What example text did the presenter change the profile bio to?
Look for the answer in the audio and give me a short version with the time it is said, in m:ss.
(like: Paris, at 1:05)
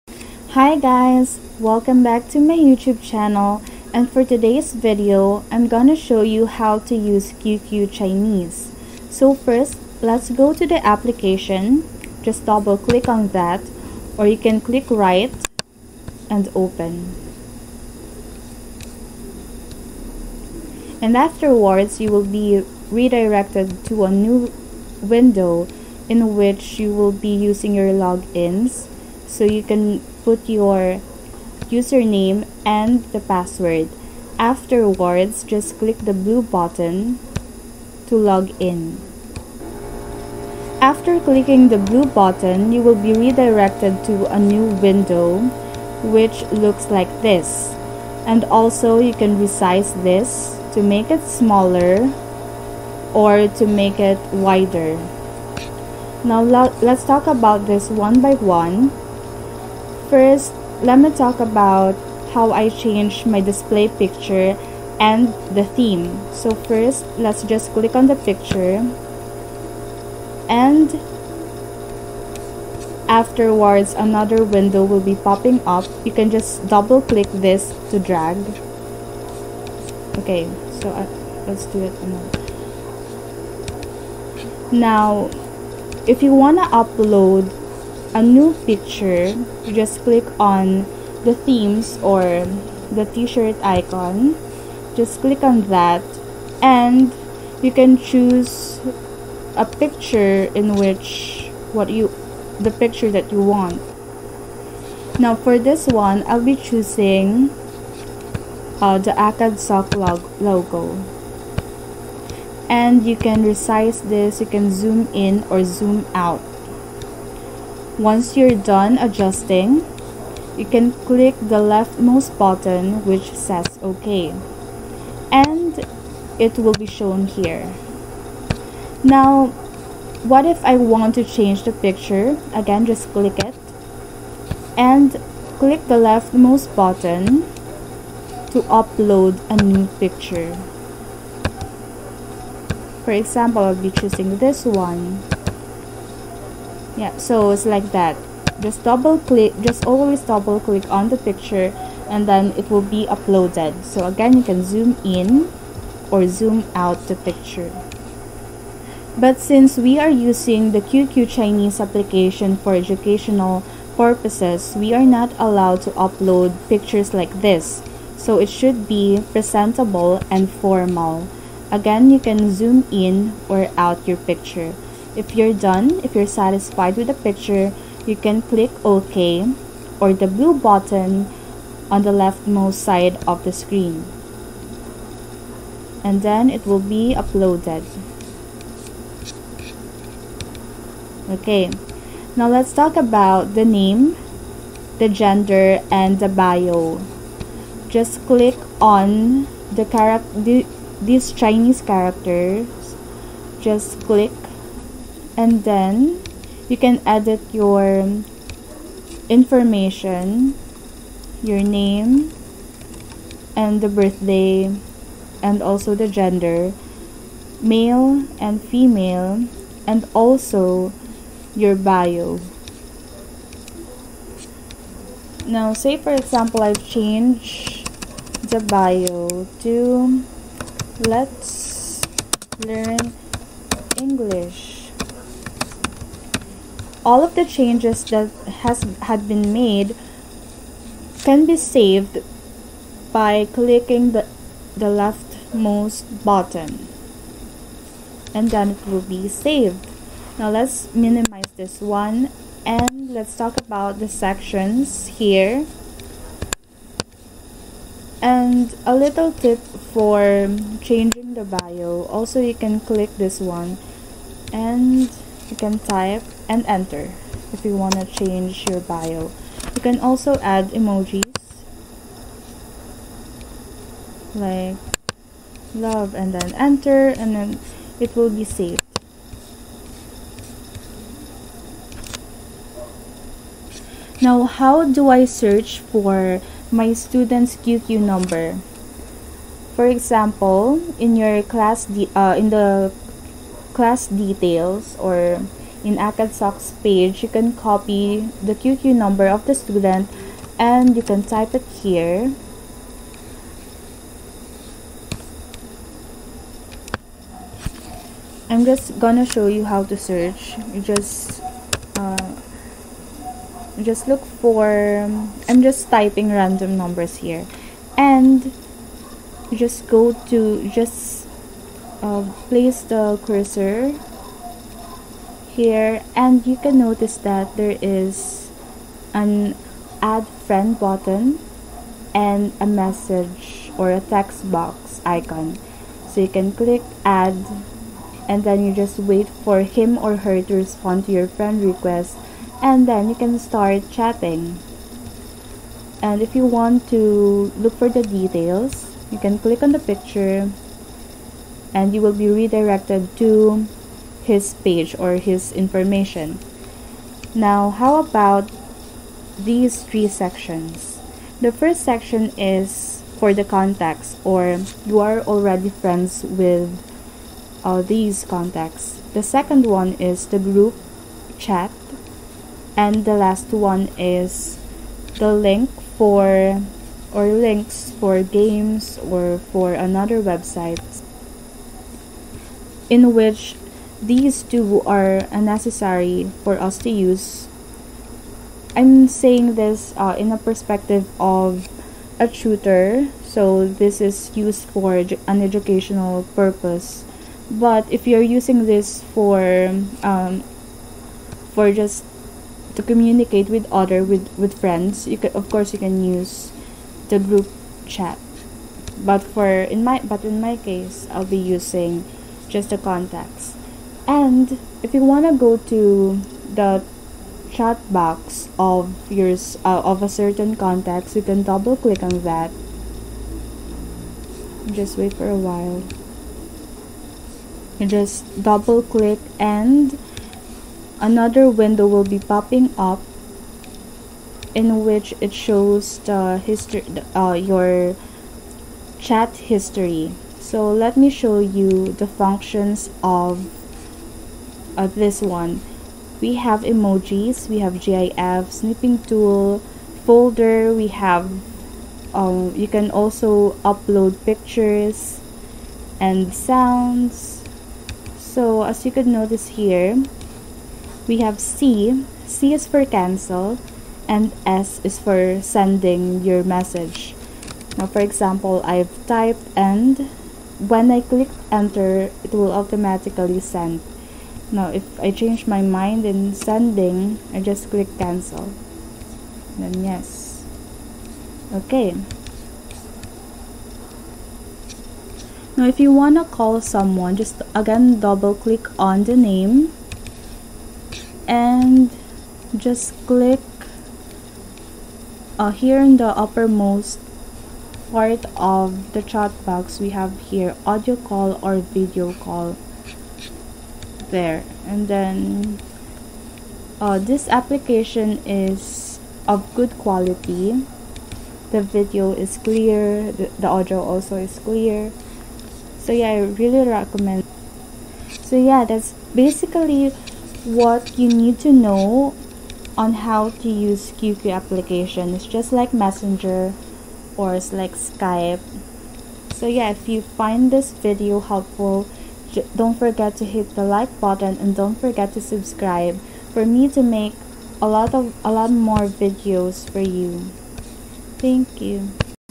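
Let's learn English, at 3:51.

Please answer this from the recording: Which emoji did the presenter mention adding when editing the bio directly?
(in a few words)
love.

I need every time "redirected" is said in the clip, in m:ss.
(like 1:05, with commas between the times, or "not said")
0:22, 0:43, 5:52.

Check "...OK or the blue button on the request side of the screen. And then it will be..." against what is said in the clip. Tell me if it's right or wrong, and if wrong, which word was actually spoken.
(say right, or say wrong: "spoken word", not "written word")
wrong: "leftmost", not "request".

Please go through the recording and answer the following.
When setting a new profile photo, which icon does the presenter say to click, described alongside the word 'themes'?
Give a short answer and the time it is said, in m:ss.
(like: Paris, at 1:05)
t-shirt icon, at 1:32.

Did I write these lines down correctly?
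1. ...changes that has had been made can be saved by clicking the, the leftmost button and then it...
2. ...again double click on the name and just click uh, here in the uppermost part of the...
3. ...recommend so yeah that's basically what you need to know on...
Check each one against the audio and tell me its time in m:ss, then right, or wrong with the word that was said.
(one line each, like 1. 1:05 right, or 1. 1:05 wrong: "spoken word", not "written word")
1. 3:57 right
2. 8:07 right
3. 8:36 right.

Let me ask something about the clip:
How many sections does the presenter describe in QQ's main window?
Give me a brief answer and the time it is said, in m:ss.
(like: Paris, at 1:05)
3, at 5:59.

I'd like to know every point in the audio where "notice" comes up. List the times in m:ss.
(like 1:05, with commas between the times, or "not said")
5:26, 7:39.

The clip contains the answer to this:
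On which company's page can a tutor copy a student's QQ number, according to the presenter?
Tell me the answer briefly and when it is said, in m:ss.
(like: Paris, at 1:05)
ACADSOC, at 4:55.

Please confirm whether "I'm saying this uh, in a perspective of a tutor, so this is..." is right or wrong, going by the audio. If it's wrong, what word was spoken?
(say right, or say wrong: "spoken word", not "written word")
right.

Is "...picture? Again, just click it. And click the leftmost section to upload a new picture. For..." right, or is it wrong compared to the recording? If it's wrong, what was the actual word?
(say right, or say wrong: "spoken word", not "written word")
wrong: "button", not "section".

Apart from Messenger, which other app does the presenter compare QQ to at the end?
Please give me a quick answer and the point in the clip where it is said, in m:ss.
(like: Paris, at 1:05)
Skype, at 8:47.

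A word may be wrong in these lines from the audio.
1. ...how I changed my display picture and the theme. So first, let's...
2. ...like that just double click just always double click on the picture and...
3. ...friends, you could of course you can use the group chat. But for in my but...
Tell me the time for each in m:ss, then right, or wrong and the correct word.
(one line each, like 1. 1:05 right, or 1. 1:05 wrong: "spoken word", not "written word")
1. 1:02 right
2. 2:27 right
3. 6:44 right.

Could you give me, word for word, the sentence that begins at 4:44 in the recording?
Now, how do I search for my student's QQ number?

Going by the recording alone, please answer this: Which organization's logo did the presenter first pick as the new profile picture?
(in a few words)
ACAD.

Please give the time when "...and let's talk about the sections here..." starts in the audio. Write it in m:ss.
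4:12.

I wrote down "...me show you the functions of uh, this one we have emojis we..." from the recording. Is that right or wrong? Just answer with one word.
right.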